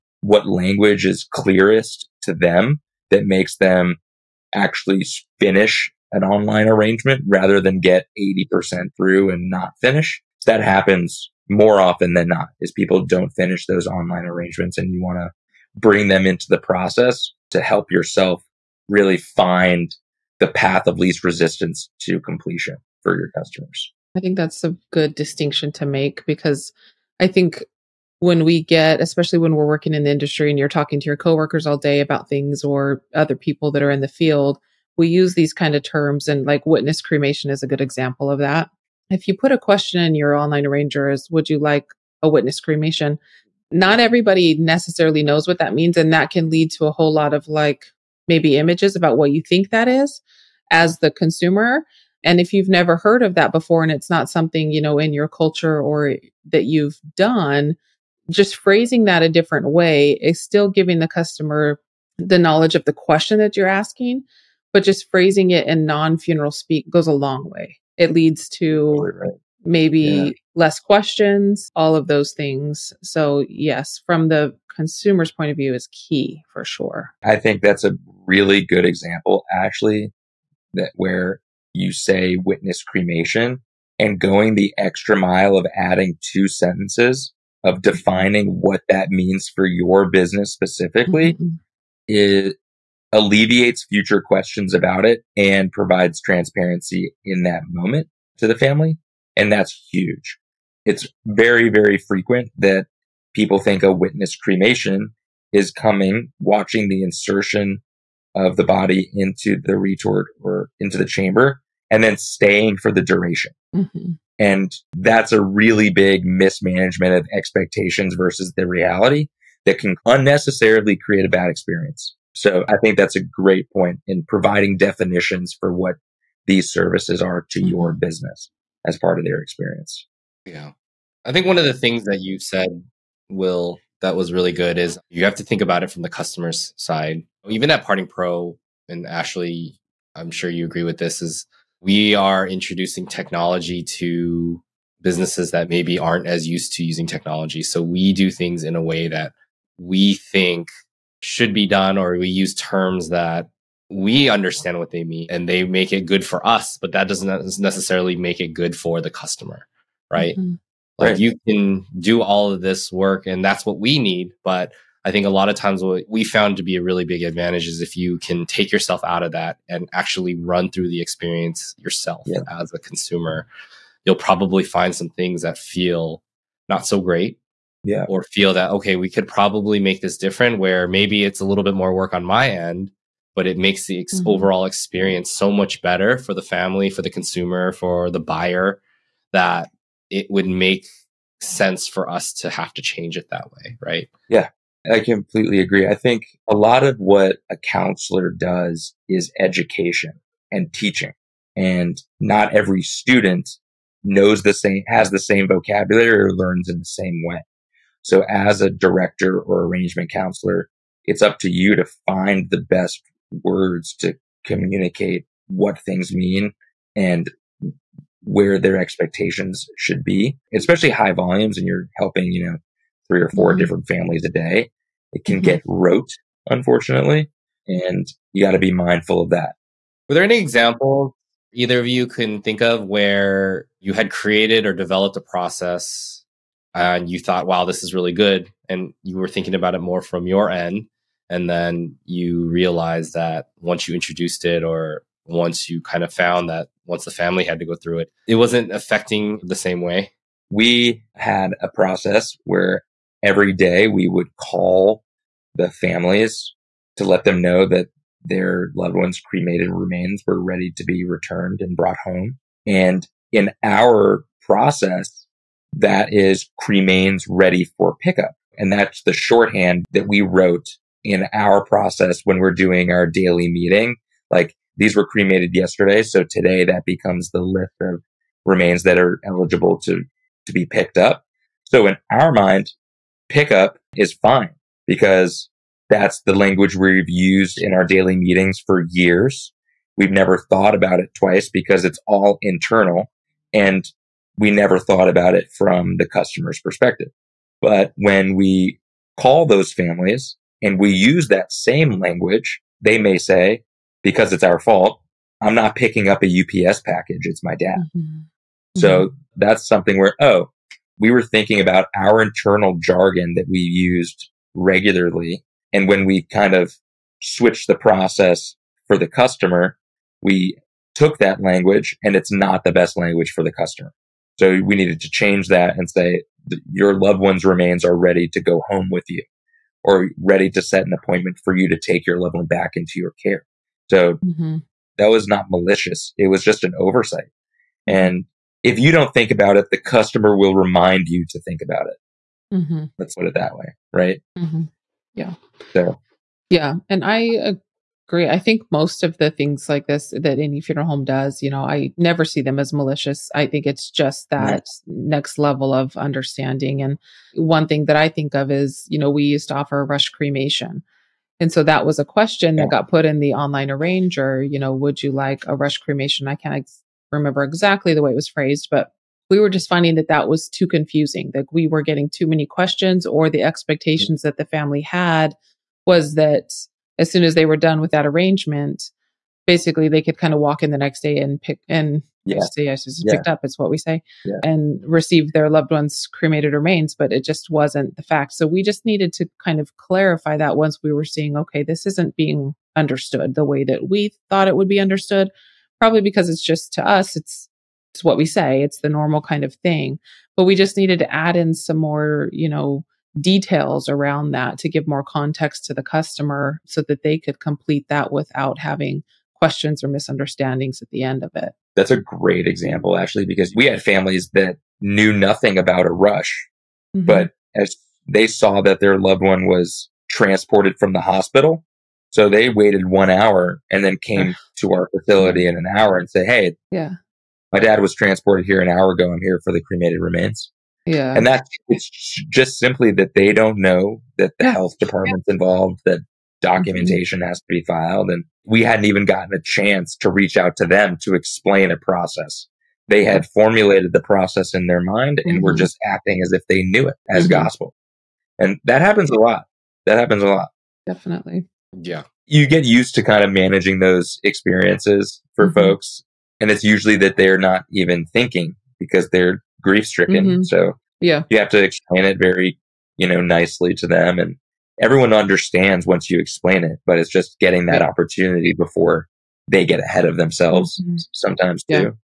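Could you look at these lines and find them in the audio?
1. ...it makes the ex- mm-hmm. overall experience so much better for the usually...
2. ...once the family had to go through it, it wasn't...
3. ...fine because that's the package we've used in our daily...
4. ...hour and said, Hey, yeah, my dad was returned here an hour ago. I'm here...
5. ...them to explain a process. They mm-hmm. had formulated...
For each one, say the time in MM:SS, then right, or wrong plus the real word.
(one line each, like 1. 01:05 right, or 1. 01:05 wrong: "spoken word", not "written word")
1. 03:03 wrong: "family", not "usually"
2. 04:06 right
3. 04:44 wrong: "language", not "package"
4. 07:05 wrong: "transported", not "returned"
5. 07:20 right.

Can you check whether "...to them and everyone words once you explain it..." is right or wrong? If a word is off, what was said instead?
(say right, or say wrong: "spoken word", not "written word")
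wrong: "understands", not "words".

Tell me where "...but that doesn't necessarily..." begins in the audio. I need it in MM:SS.
02:36.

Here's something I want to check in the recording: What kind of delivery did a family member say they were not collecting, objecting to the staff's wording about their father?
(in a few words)
UPS package.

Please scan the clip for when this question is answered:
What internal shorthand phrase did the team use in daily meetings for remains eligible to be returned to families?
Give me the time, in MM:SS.
04:26.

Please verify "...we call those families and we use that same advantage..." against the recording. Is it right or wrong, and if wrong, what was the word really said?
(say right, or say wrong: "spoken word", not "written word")
wrong: "language", not "advantage".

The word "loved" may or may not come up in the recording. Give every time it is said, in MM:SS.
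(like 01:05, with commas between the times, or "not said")
04:18, 05:26, 05:32, 06:25, 06:59.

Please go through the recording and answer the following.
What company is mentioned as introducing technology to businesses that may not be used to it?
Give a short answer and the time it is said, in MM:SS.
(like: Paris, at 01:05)
Parting Pro, at 02:17.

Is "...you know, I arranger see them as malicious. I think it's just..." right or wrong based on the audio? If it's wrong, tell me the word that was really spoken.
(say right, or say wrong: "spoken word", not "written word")
wrong: "never", not "arranger".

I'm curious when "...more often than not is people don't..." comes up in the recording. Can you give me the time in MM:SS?
00:11.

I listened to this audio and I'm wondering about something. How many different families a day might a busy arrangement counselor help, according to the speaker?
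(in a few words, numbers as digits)
3 or 4.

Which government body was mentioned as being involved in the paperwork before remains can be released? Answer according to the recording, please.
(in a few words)
health department.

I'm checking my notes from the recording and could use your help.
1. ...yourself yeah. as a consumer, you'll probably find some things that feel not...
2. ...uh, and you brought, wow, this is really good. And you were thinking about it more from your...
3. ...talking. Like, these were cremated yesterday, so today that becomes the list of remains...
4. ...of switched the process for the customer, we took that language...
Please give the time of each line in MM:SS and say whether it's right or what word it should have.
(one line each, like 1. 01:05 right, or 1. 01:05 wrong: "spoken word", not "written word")
1. 02:51 right
2. 03:56 wrong: "thought", not "brought"
3. 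04:33 wrong: "meeting", not "talking"
4. 05:16 right.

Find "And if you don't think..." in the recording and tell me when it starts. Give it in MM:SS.
05:37.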